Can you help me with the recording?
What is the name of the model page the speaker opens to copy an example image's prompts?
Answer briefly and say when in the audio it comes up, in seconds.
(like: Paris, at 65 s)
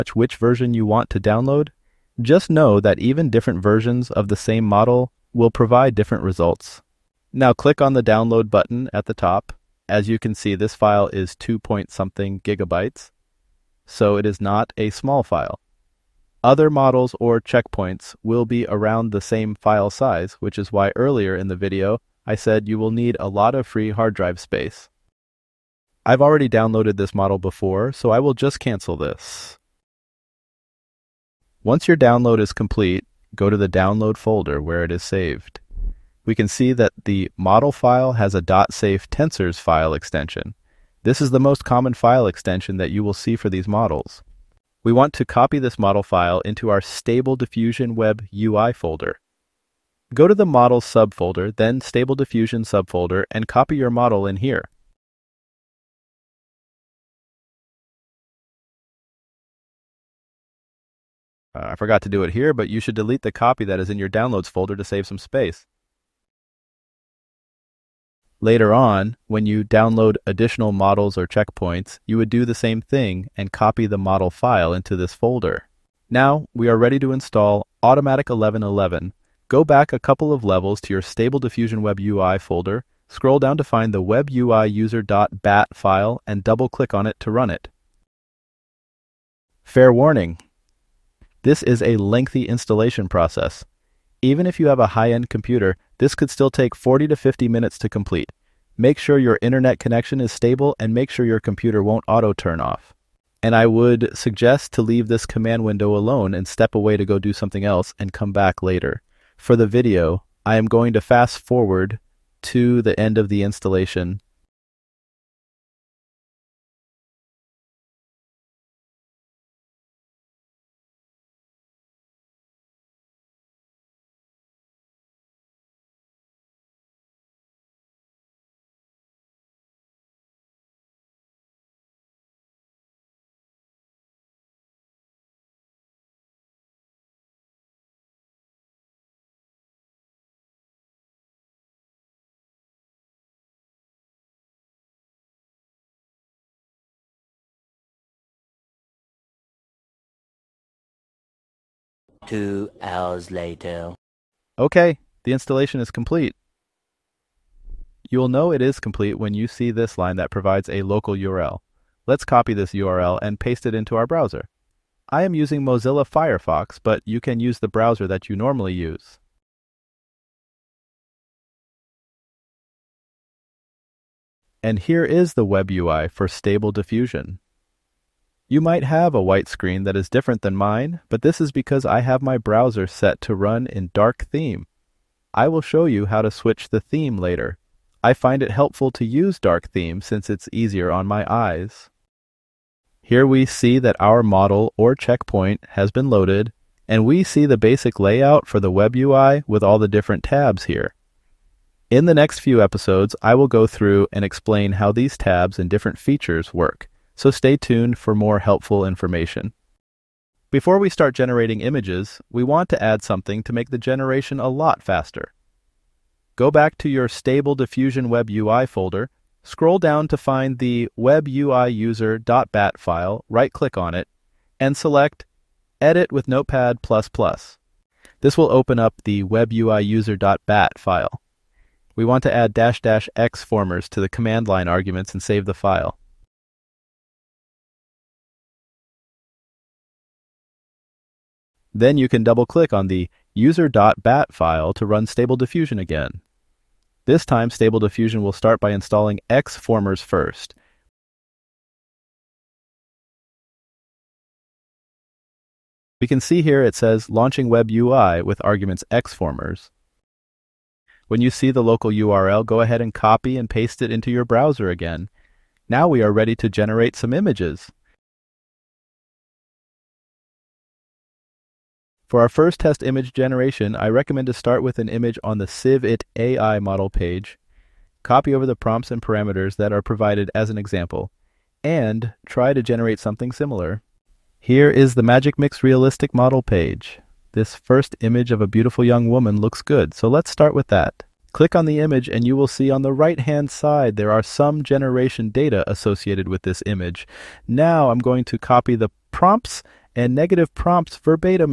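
Magic Mix Realistic, at 285 s.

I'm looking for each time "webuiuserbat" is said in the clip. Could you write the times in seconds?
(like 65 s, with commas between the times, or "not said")
84 s, 220 s, 229 s.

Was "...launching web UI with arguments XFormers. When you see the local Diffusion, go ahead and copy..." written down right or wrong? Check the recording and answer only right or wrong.
wrong.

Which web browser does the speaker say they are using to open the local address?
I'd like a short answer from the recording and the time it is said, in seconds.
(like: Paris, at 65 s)
Mozilla Firefox, at 165 s.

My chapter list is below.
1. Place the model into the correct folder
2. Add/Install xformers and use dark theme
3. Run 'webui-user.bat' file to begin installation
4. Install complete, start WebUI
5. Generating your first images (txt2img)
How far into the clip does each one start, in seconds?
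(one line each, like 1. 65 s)
1. 23 s
2. 208 s
3. 74 s
4. 153 s
5. 268 s.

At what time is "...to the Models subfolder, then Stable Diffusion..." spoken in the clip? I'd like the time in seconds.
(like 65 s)
50 s.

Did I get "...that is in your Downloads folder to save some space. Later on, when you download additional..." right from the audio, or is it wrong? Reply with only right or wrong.
right.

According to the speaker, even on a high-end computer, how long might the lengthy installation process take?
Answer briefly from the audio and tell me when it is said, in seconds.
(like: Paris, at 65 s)
40 to 50 minutes, at 96 s.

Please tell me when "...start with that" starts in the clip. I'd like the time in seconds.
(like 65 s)
290 s.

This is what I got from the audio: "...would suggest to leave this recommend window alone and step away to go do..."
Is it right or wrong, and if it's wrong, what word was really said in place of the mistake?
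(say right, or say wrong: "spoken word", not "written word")
wrong: "command", not "recommend".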